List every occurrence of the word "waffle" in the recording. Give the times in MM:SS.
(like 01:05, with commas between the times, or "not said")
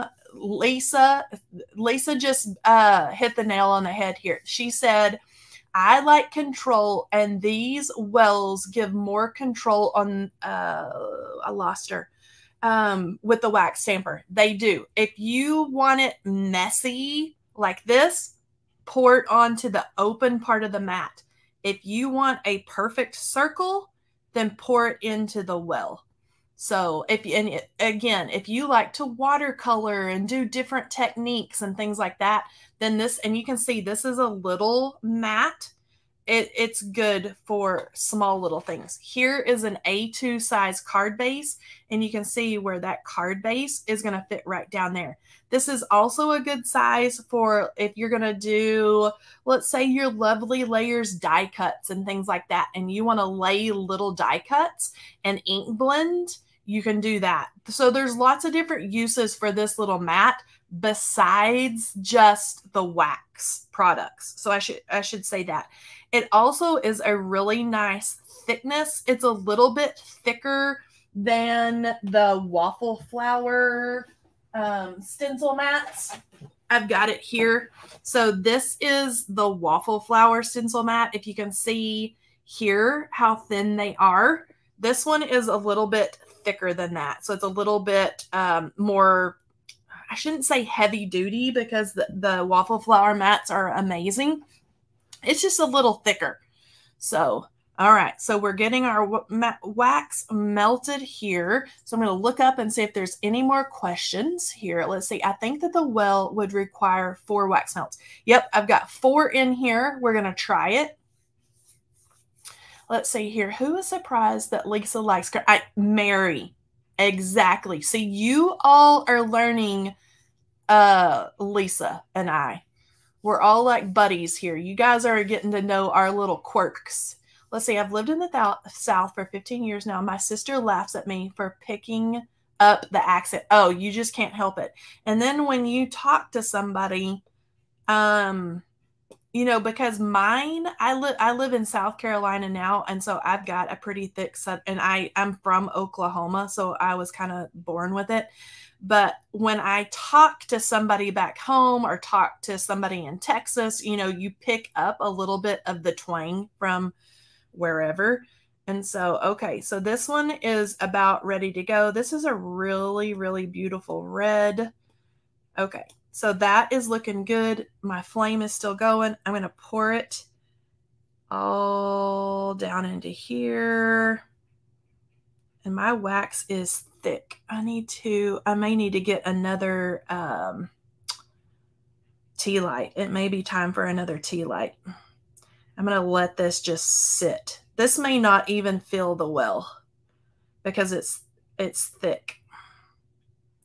01:12, 01:19, 01:32.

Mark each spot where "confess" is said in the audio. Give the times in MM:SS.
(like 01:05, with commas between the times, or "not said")
not said.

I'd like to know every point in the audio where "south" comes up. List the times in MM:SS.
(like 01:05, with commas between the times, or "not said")
02:08, 02:21.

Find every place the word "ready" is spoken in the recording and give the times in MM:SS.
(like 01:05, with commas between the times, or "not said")
02:41.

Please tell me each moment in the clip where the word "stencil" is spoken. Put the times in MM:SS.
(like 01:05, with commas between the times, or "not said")
01:15, 01:20.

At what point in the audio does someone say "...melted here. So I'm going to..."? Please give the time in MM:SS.
01:40.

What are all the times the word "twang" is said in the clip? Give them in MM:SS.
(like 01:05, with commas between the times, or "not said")
02:35.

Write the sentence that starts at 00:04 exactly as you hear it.
She said, I like control, and these wells give more control on.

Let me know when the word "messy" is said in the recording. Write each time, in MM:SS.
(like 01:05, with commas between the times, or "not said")
00:16.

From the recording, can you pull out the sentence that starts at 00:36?
It, it's good for small little things.